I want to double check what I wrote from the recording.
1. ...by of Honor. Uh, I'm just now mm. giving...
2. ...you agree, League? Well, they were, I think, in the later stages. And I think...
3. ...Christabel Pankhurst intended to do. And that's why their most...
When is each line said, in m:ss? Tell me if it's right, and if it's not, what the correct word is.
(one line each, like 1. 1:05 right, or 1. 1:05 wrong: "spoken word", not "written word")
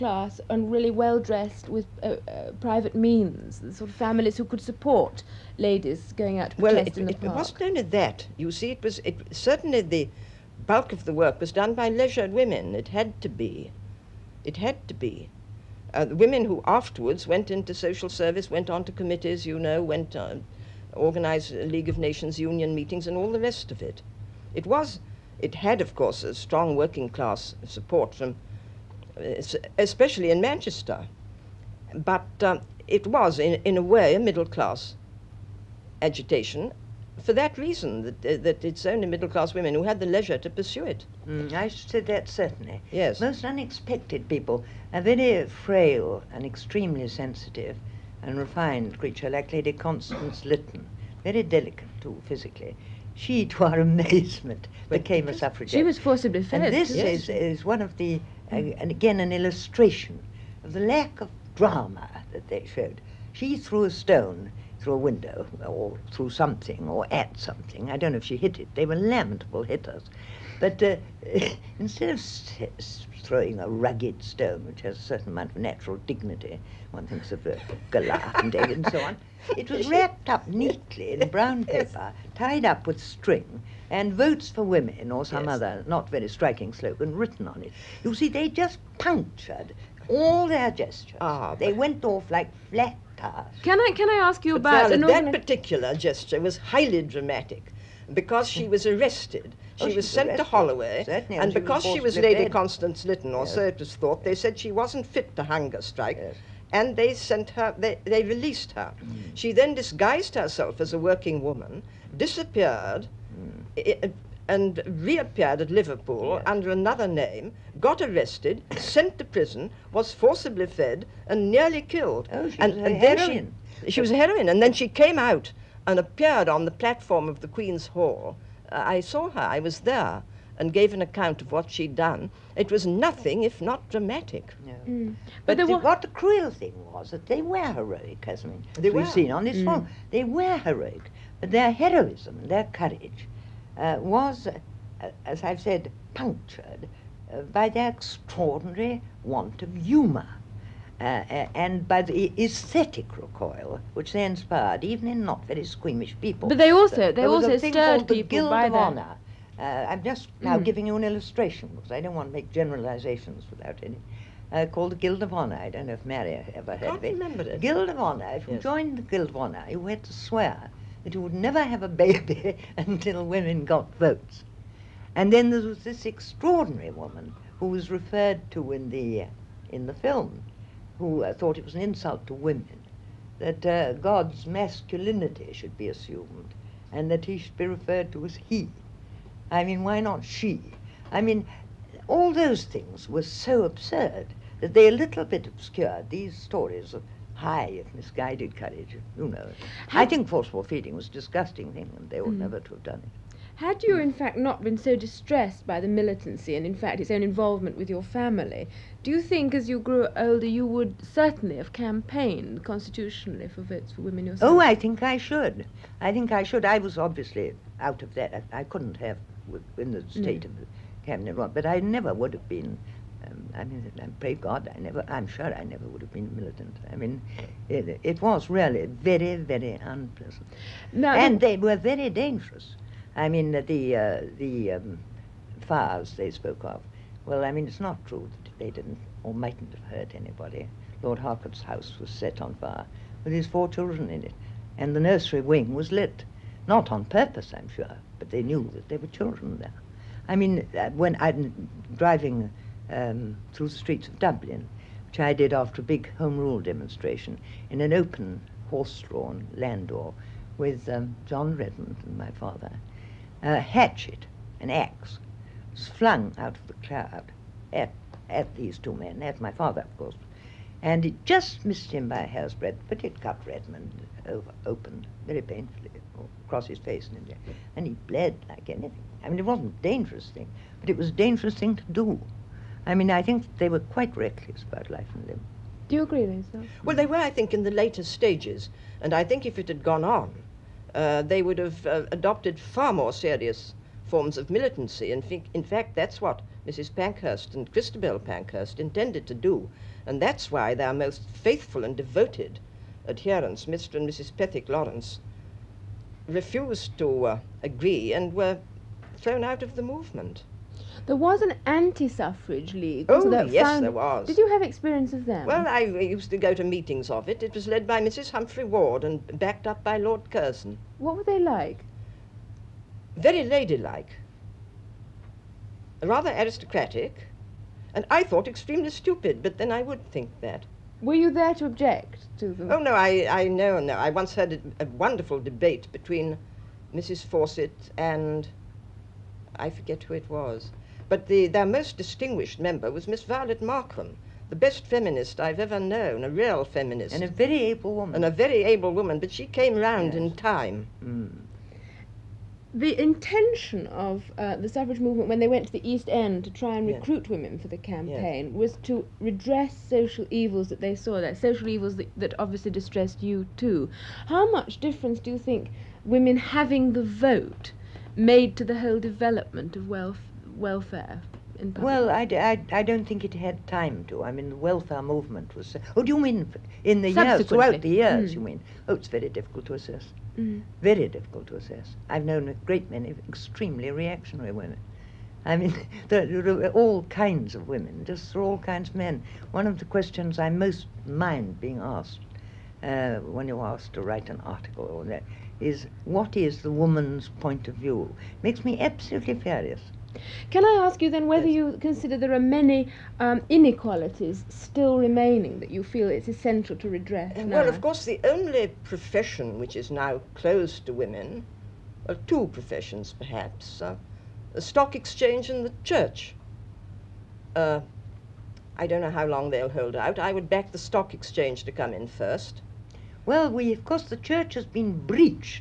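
1. 2:38 right
2. 4:45 wrong: "Lisa", not "League"
3. 4:57 right.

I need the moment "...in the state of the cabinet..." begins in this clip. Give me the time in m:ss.
3:39.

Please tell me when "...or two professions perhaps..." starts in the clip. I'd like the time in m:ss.
6:52.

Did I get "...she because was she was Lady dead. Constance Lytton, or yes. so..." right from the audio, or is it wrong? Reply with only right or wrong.
right.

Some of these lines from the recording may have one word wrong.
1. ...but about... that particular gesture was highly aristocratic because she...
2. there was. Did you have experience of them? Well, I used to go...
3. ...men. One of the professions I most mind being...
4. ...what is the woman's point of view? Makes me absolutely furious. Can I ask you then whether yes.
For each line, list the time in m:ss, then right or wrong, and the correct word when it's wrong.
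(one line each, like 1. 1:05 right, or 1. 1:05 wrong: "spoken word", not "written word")
1. 1:34 wrong: "dramatic", not "aristocratic"
2. 5:13 right
3. 6:28 wrong: "questions", not "professions"
4. 6:36 right.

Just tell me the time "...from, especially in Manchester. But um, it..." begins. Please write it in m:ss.
0:28.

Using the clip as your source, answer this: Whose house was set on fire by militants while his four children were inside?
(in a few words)
Lord Harcourt.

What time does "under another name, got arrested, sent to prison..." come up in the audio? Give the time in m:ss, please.
1:56.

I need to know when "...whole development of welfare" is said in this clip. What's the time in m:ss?
6:08.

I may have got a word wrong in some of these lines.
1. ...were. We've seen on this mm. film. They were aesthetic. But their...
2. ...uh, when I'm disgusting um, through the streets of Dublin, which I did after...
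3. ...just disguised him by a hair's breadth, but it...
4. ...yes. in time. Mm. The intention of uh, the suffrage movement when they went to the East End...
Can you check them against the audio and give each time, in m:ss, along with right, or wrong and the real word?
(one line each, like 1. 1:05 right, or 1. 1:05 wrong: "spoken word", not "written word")
1. 2:18 wrong: "heroic", not "aesthetic"
2. 4:10 wrong: "driving", not "disgusting"
3. 4:31 wrong: "missed", not "disguised"
4. 5:50 right.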